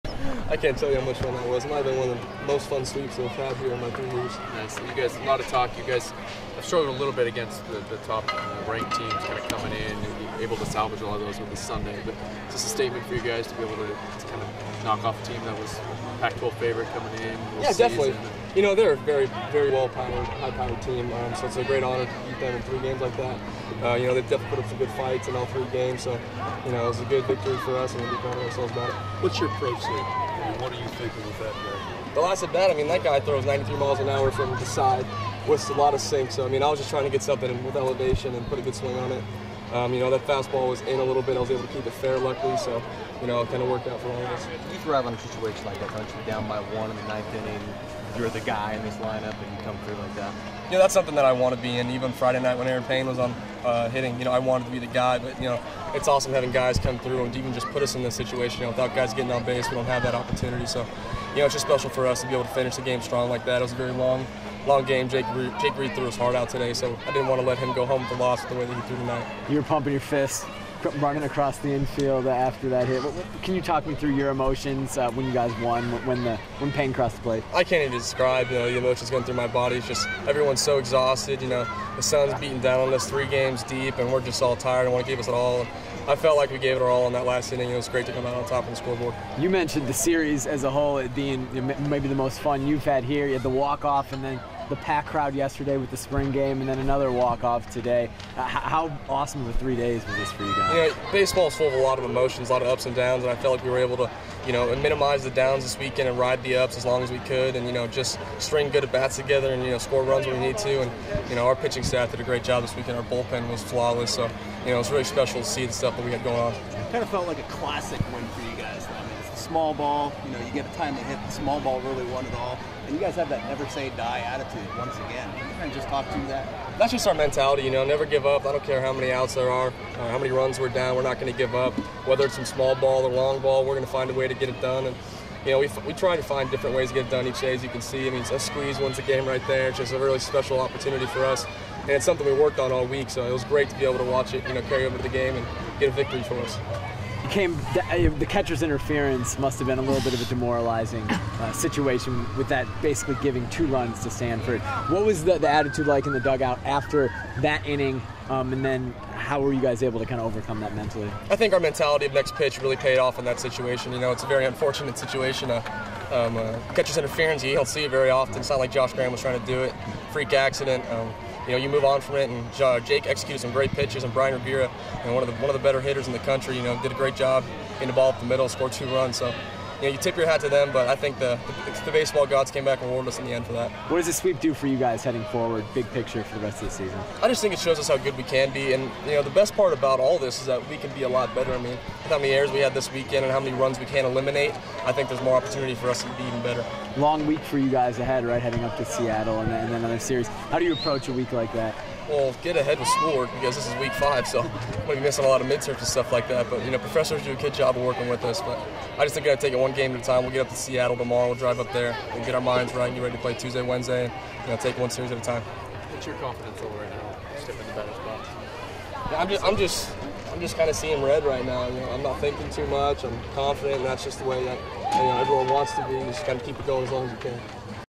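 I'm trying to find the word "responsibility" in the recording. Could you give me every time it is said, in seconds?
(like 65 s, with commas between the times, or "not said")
not said.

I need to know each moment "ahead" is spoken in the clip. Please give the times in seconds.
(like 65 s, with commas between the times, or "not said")
197 s, 202 s.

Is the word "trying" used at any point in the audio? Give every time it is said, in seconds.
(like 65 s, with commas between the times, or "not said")
36 s, 169 s.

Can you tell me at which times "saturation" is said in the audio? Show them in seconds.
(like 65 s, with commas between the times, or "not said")
not said.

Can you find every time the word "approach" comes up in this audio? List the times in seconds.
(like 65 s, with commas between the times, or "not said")
29 s, 200 s.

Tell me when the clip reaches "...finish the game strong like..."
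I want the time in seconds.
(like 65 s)
62 s.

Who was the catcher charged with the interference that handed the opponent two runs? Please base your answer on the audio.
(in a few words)
Josh Graham.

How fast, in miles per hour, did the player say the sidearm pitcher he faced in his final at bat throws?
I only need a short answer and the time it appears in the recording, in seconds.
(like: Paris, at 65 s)
93, at 33 s.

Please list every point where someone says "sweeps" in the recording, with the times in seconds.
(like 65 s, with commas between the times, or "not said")
2 s, 184 s.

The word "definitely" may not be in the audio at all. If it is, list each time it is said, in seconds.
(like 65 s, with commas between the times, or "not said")
17 s, 24 s.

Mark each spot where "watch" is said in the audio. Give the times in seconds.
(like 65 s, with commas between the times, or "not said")
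144 s.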